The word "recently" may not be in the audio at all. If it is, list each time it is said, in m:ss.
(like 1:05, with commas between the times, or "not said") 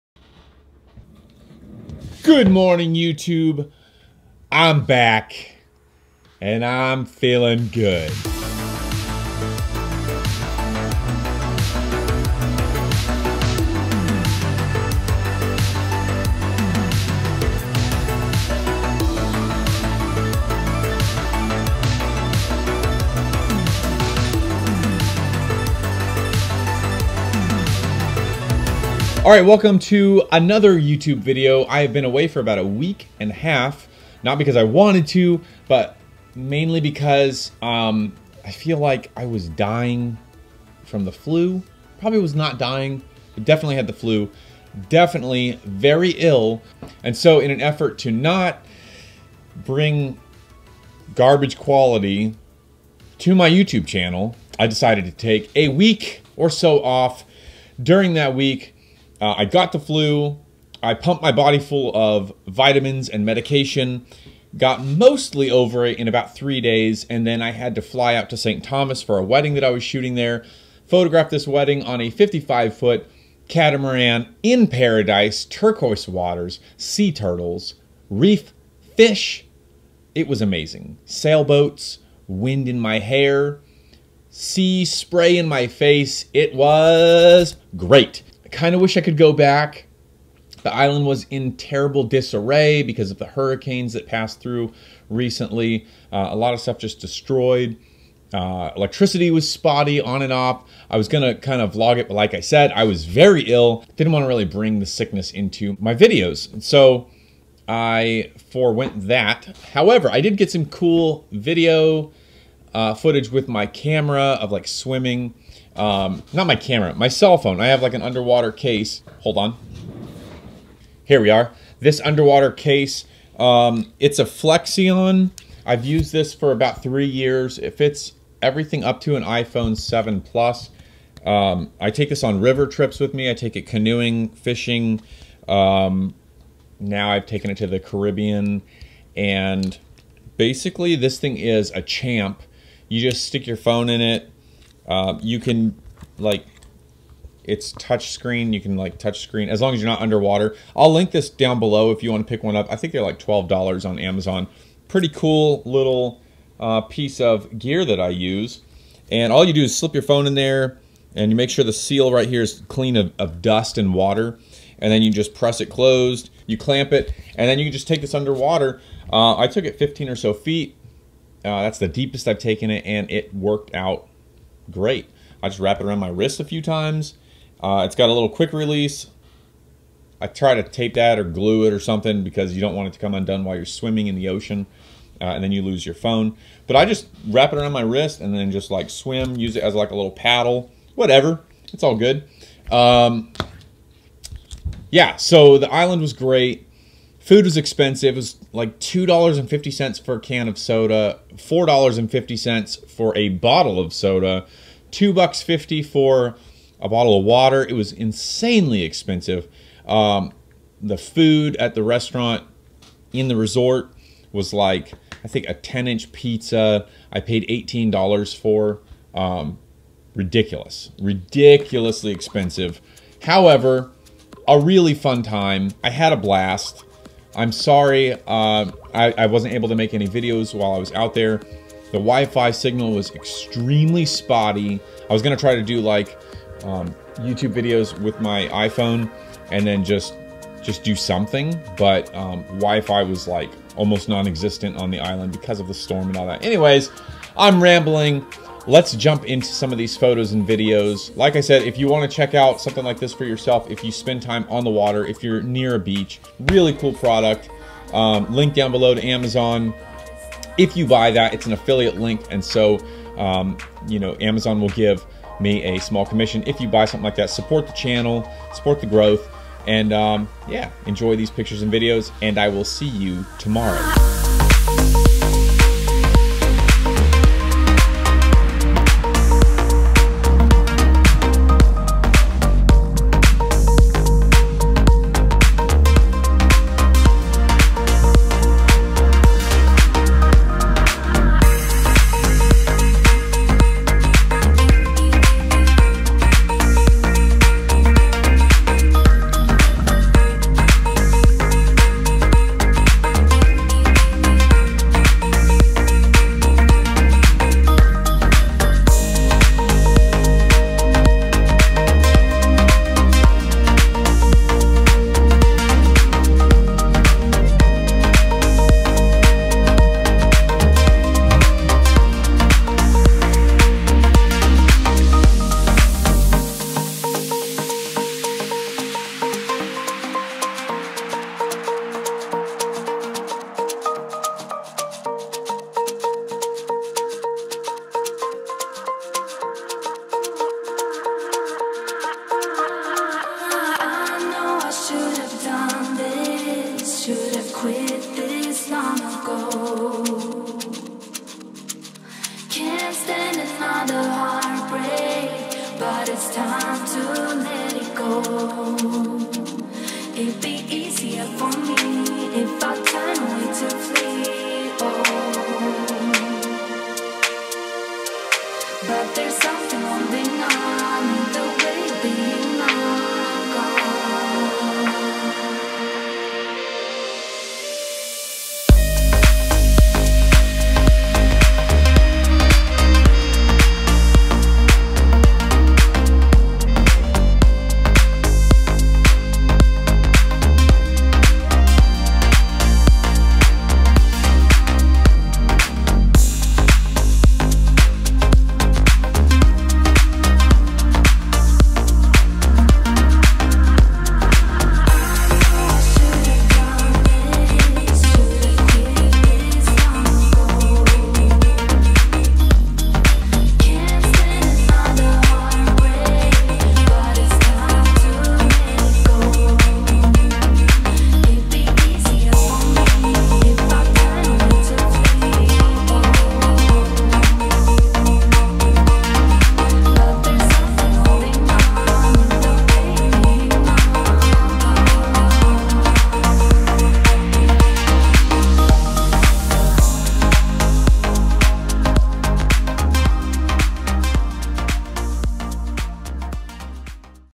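1:35.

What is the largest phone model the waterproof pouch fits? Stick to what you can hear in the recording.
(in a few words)
iPhone 7 Plus.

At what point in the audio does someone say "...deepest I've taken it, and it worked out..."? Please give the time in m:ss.
2:51.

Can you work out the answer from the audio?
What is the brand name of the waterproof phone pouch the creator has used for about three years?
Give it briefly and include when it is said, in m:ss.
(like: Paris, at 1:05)
Flexion, at 2:04.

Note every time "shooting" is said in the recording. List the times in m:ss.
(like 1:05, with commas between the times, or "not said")
1:09.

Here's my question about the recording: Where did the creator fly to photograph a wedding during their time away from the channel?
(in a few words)
St. Thomas.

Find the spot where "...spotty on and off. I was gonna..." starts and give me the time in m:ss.
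1:39.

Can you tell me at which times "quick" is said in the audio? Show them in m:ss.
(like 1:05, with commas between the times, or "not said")
2:58.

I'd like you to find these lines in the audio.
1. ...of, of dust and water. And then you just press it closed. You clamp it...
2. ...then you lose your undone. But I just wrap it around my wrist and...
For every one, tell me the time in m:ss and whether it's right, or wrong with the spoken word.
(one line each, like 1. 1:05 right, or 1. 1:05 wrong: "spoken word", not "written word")
1. 2:42 right
2. 3:05 wrong: "phone", not "undone".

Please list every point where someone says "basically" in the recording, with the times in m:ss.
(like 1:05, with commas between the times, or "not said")
2:20.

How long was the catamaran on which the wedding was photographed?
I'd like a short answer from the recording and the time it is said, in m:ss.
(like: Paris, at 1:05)
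55 foot, at 1:12.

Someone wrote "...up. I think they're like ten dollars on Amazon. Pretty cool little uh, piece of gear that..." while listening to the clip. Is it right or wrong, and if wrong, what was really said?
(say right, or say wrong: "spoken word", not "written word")
wrong: "twelve", not "ten".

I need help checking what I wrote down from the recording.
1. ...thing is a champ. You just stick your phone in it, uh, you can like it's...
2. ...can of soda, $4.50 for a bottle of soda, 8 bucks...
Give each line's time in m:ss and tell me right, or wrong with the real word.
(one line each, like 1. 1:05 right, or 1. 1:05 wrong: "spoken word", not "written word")
1. 2:21 right
2. 3:20 wrong: "2", not "8".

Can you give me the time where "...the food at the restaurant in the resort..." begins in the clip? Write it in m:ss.
3:30.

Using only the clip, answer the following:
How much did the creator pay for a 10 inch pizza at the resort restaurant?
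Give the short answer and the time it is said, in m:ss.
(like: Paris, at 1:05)
$18, at 3:37.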